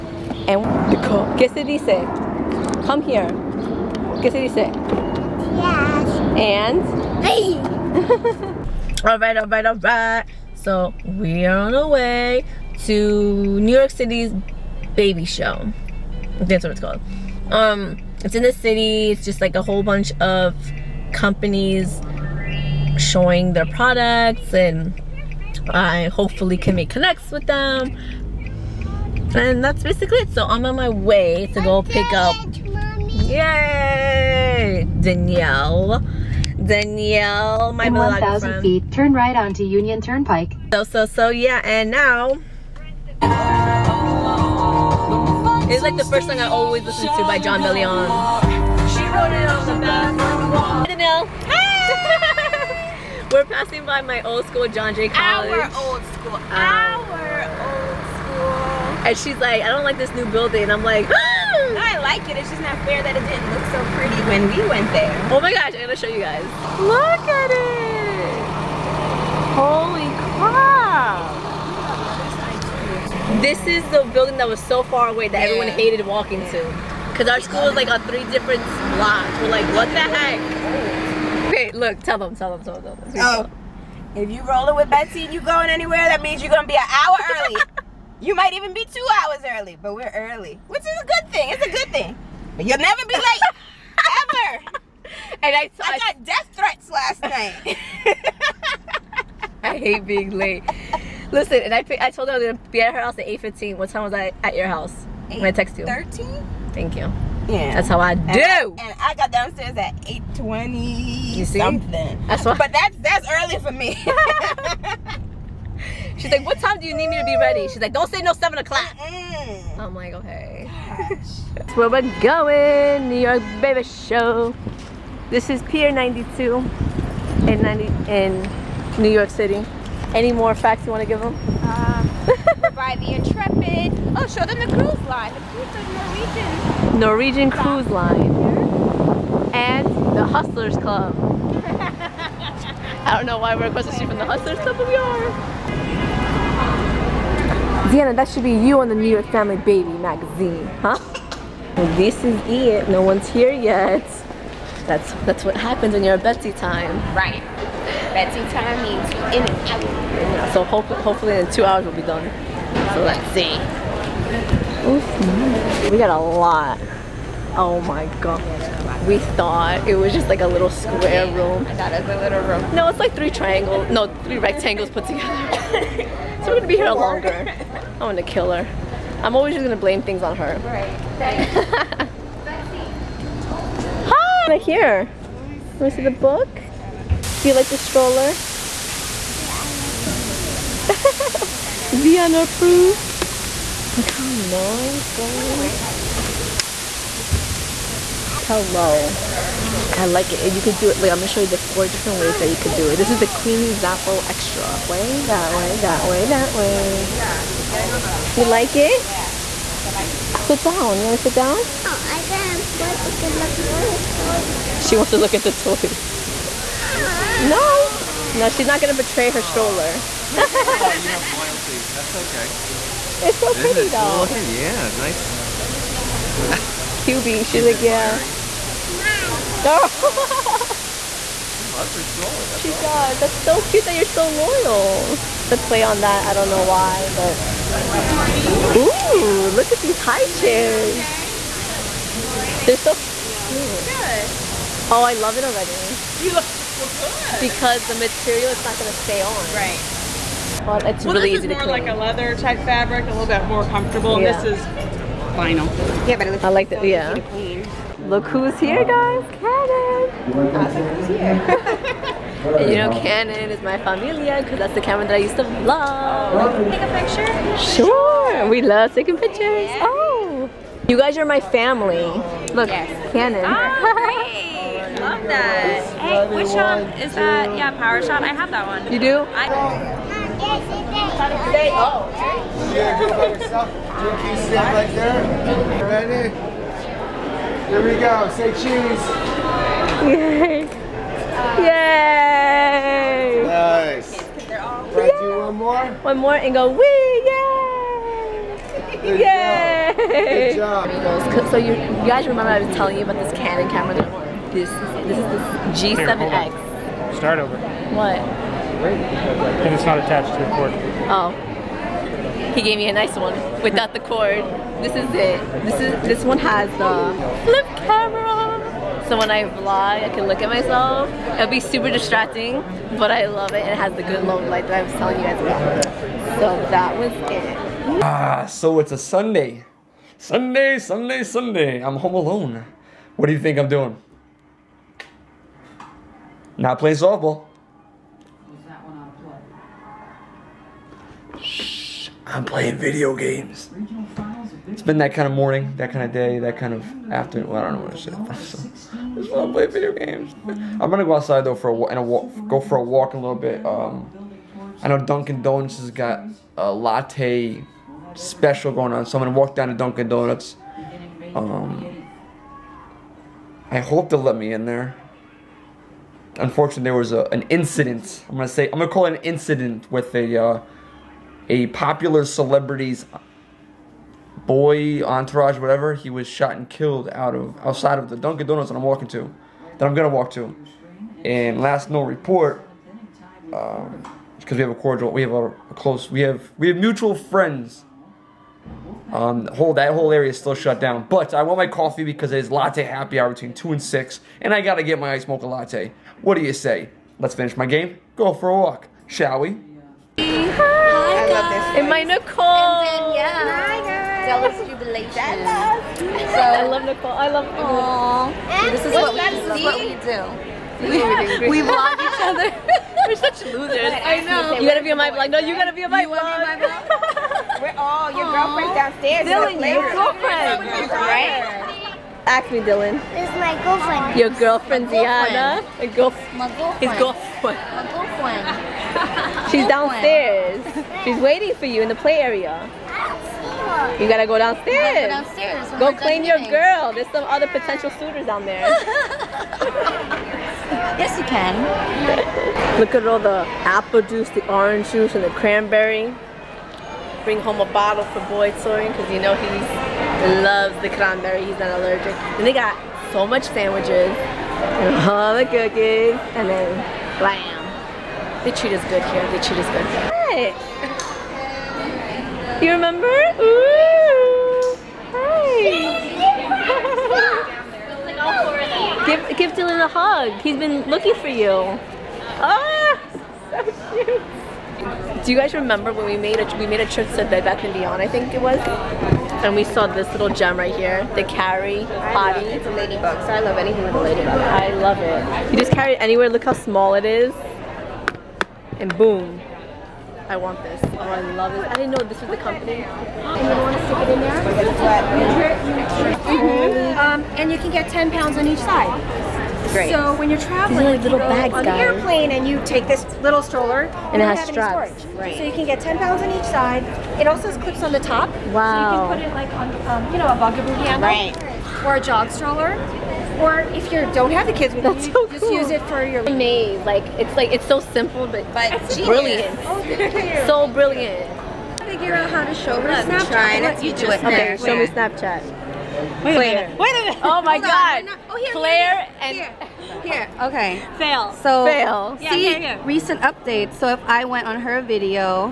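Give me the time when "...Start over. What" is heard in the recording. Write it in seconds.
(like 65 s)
307 s.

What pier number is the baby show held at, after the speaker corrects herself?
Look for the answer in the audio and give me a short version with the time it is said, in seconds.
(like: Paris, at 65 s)
Pier 90, at 127 s.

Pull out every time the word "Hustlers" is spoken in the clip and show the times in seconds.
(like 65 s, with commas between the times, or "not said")
140 s, 144 s.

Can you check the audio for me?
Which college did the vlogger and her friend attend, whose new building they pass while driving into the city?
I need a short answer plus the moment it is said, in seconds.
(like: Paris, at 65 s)
John Jay College, at 54 s.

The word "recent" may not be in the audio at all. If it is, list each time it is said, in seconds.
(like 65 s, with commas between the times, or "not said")
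532 s.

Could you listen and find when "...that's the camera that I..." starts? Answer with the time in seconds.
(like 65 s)
264 s.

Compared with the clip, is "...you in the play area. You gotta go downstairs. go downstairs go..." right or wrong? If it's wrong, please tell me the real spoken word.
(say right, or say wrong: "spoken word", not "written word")
right.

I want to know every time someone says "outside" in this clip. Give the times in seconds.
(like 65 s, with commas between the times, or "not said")
351 s, 377 s.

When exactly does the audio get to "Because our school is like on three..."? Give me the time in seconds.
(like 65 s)
77 s.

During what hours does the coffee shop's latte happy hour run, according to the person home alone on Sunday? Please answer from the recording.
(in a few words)
2 to 6.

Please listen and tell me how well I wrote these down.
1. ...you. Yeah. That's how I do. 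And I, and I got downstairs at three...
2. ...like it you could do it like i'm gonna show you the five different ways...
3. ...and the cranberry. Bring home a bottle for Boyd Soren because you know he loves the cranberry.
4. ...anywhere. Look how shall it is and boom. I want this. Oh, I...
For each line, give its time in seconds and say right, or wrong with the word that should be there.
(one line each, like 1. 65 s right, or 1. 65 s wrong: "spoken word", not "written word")
1. 106 s wrong: "eight", not "three"
2. 200 s wrong: "four", not "five"
3. 445 s right
4. 486 s wrong: "small", not "shall".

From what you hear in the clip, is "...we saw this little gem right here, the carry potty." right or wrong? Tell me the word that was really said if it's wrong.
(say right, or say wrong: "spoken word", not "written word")
right.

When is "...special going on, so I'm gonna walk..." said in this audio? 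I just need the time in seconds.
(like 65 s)
358 s.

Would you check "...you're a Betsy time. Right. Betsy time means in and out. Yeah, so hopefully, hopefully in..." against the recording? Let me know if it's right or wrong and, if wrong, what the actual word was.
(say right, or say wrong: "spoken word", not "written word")
right.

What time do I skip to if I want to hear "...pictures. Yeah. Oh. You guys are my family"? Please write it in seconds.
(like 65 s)
269 s.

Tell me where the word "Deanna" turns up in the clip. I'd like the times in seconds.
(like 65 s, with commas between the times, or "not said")
147 s.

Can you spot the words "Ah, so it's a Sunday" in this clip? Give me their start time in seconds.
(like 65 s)
328 s.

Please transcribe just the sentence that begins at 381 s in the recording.
And last known report, because um, we have a cordial, we have a, a, close, we have we have mutual friends.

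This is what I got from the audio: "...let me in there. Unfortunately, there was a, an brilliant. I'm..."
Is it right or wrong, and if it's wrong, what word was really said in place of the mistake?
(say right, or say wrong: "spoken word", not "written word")
wrong: "incident", not "brilliant".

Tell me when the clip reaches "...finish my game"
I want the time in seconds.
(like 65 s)
397 s.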